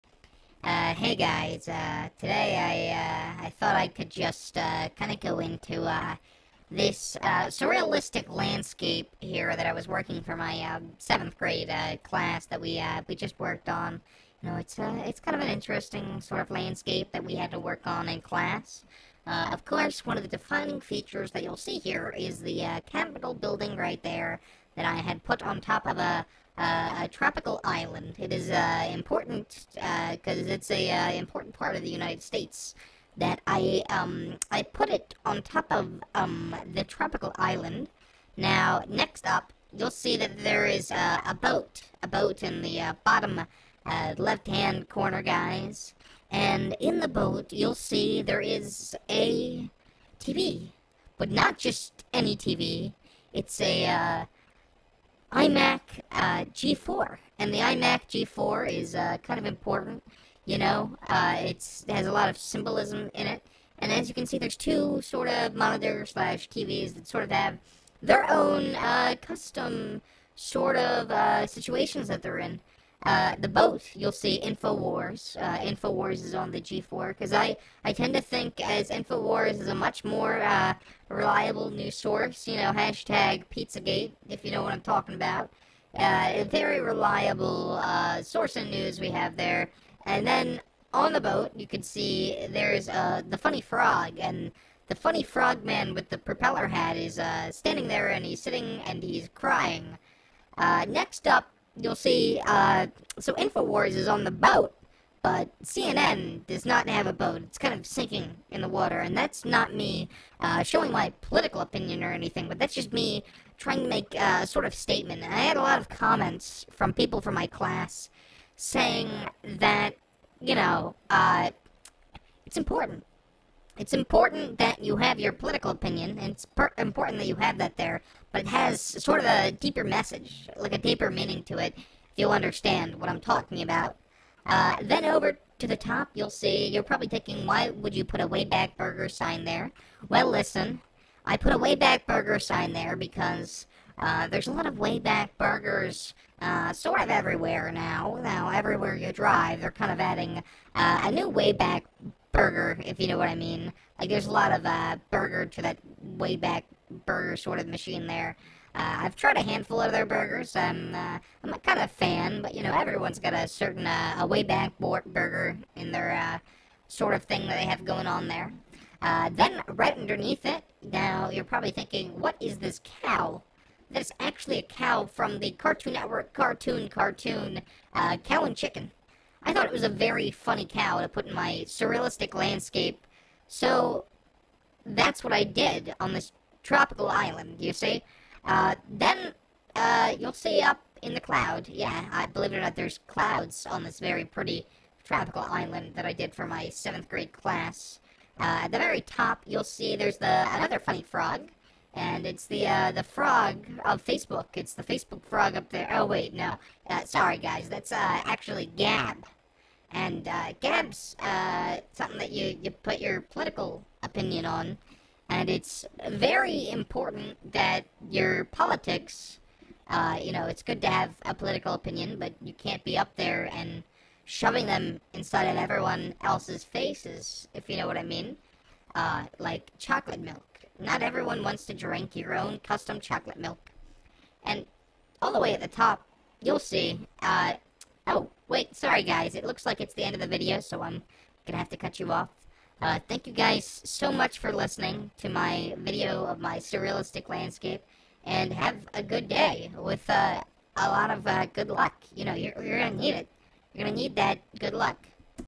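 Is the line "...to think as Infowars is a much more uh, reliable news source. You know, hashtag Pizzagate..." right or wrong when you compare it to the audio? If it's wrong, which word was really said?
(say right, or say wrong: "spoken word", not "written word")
right.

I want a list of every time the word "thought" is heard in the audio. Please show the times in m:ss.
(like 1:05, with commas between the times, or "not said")
0:03, 2:59.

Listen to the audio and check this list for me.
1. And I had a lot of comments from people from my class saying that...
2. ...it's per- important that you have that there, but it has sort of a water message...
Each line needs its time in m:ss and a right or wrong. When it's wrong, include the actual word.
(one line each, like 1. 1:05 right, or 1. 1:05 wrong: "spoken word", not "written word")
1. 1:55 right
2. 2:06 wrong: "deeper", not "water".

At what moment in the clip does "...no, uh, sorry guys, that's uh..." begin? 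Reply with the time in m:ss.
3:26.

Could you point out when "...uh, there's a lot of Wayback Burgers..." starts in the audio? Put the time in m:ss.
2:23.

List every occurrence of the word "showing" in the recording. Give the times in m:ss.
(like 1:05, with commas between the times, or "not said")
1:50.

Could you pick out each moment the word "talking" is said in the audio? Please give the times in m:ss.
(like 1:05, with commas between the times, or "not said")
1:24, 2:13.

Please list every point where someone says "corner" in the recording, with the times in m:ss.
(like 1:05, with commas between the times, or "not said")
0:44.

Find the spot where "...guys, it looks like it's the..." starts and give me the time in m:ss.
3:59.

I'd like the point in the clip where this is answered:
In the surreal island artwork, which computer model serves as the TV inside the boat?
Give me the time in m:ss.
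0:55.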